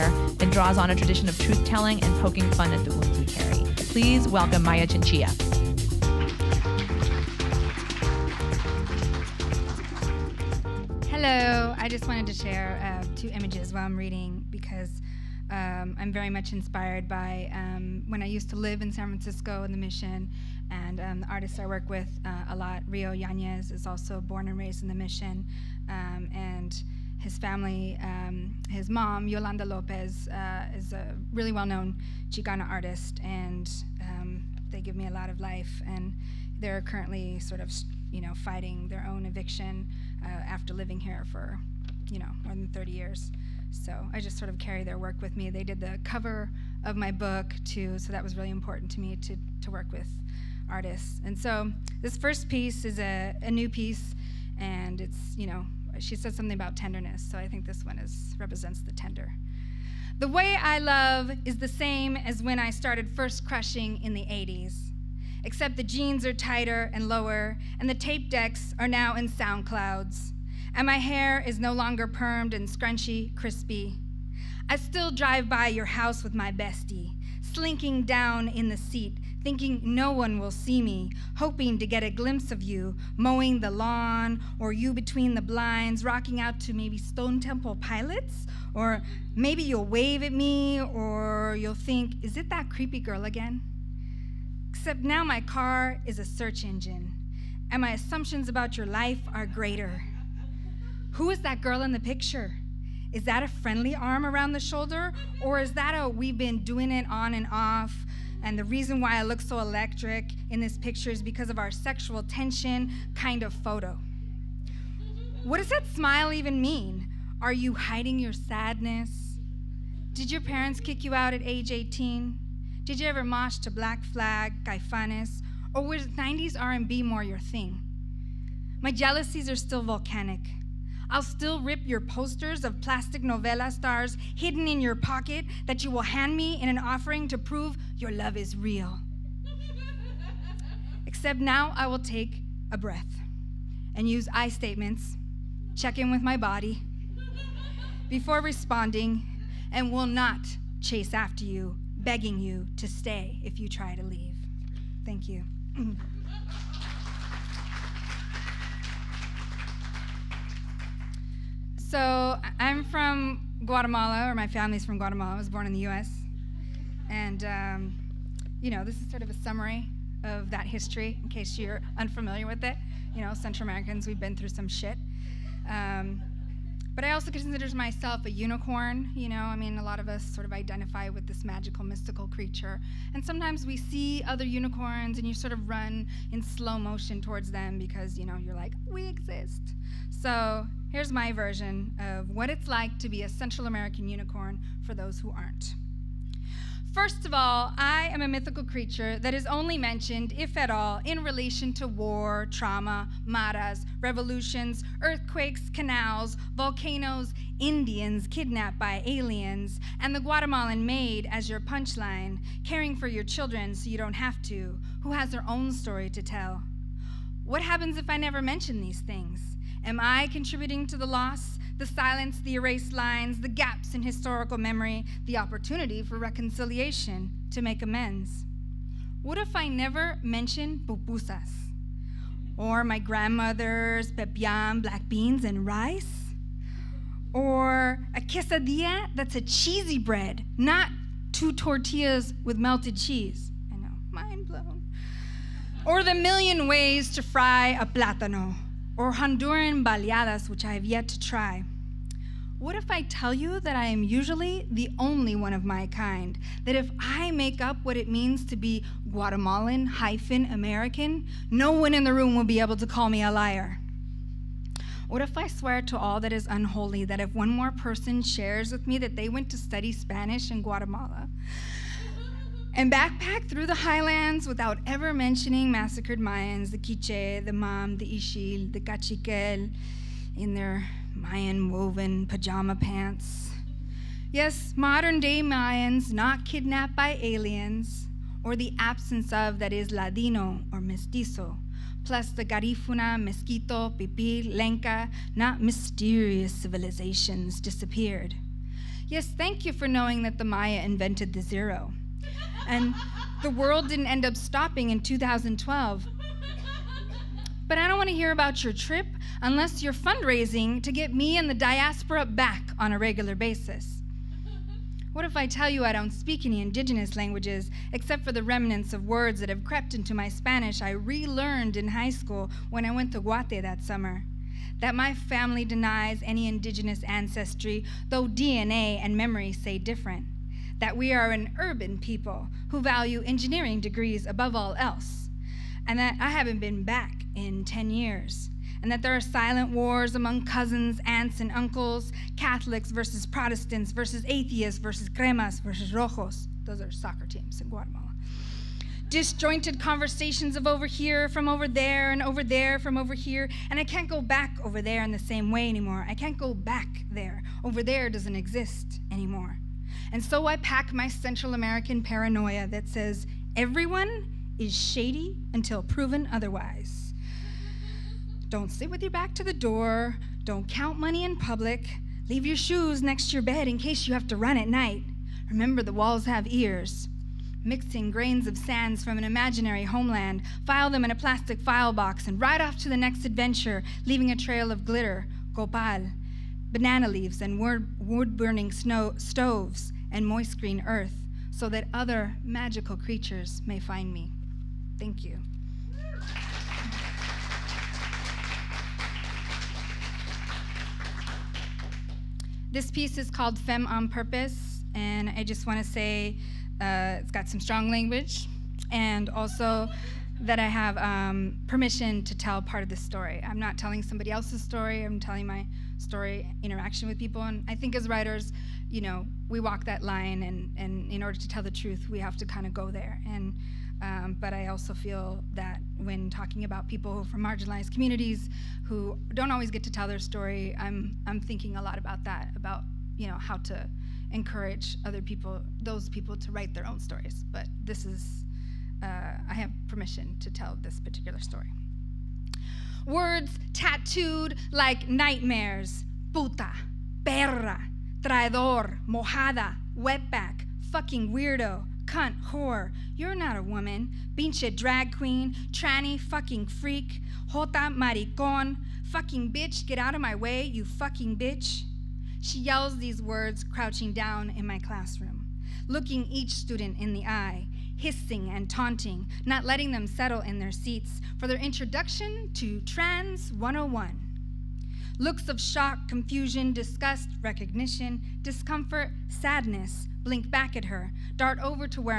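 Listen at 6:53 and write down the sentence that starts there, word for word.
I'm not telling somebody else's story.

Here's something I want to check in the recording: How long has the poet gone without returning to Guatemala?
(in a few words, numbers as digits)
10 years.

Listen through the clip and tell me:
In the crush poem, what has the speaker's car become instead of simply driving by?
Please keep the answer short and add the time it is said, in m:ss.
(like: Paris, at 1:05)
a search engine, at 1:36.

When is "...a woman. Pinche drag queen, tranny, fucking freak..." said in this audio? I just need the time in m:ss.
7:33.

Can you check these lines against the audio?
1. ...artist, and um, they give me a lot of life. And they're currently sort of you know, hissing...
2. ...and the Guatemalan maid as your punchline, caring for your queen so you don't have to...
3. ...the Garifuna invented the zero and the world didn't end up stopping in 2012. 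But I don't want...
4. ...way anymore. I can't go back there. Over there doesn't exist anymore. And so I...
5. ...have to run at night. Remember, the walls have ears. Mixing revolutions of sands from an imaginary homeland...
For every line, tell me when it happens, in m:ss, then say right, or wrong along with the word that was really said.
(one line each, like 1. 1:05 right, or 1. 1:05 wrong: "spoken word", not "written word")
1. 0:32 wrong: "fighting", not "hissing"
2. 3:29 wrong: "children", not "queen"
3. 5:00 wrong: "Maya", not "Garifuna"
4. 5:55 right
5. 6:14 wrong: "grains", not "revolutions".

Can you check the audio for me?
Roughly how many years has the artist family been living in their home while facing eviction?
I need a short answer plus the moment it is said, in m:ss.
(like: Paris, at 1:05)
more than 30, at 0:42.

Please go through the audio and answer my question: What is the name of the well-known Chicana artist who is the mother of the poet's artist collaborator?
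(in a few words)
Yolanda Lopez.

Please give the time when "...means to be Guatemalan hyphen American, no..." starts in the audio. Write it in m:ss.
4:18.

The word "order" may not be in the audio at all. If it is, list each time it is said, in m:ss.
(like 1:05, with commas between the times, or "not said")
7:01.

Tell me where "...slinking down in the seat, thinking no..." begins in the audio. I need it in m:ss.
1:17.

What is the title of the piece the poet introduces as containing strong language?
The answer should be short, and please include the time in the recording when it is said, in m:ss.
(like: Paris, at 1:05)
Femme on Purpose, at 6:43.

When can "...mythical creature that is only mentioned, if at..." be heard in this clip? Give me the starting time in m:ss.
3:18.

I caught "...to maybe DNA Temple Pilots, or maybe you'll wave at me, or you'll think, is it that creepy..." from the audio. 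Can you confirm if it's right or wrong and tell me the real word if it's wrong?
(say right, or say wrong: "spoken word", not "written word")
wrong: "Stone", not "DNA".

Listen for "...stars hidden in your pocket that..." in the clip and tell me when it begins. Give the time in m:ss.
2:13.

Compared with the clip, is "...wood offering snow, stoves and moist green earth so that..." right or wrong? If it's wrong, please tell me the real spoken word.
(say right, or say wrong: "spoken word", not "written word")
wrong: "burning", not "offering".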